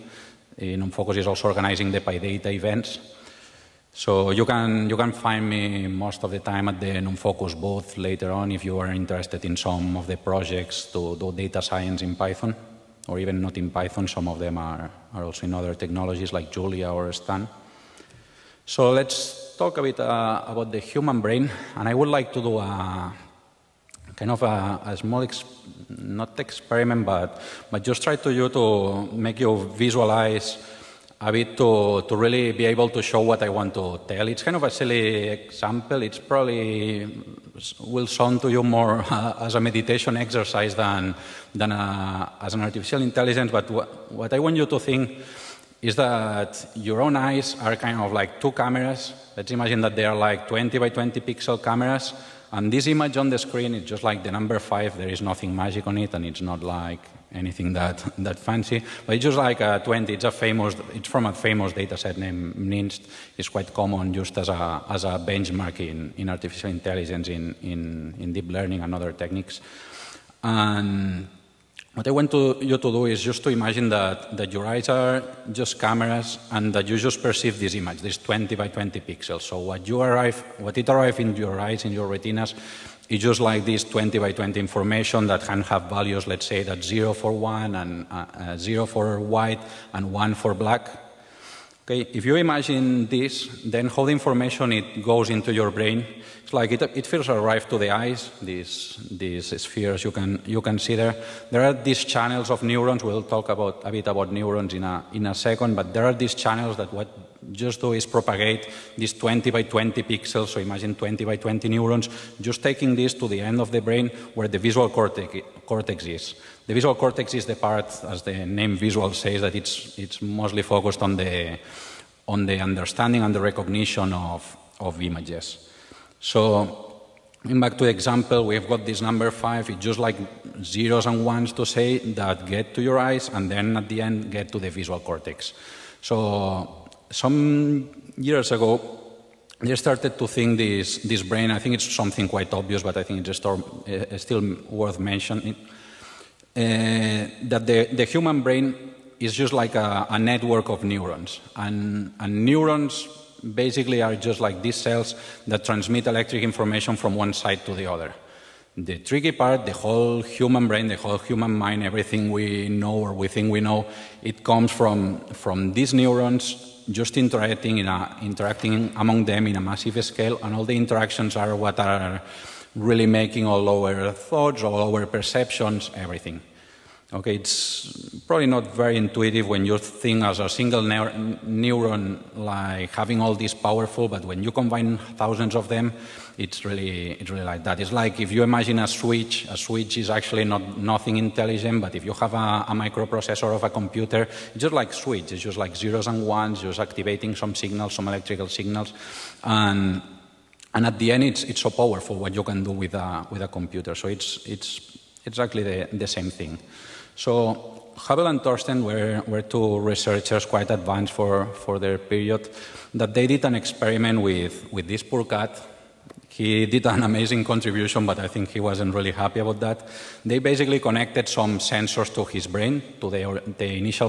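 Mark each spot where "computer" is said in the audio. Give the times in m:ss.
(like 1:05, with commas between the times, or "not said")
3:13, 3:23.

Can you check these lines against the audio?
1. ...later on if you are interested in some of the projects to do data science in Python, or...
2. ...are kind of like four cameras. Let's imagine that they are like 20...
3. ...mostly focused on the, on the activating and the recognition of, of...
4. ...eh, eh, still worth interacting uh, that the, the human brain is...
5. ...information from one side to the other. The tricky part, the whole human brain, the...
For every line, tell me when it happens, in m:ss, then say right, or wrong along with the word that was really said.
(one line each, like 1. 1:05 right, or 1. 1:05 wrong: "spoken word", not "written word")
1. 0:07 right
2. 0:47 wrong: "two", not "four"
3. 2:00 wrong: "understanding", not "activating"
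4. 2:23 wrong: "mentioning", not "interacting"
5. 2:36 right.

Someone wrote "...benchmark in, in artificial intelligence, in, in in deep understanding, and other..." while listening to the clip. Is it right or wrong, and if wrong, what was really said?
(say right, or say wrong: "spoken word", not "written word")
wrong: "learning", not "understanding".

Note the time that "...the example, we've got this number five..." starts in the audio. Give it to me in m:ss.
2:07.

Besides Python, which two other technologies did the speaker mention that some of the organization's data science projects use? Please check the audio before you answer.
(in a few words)
Julia or Stan.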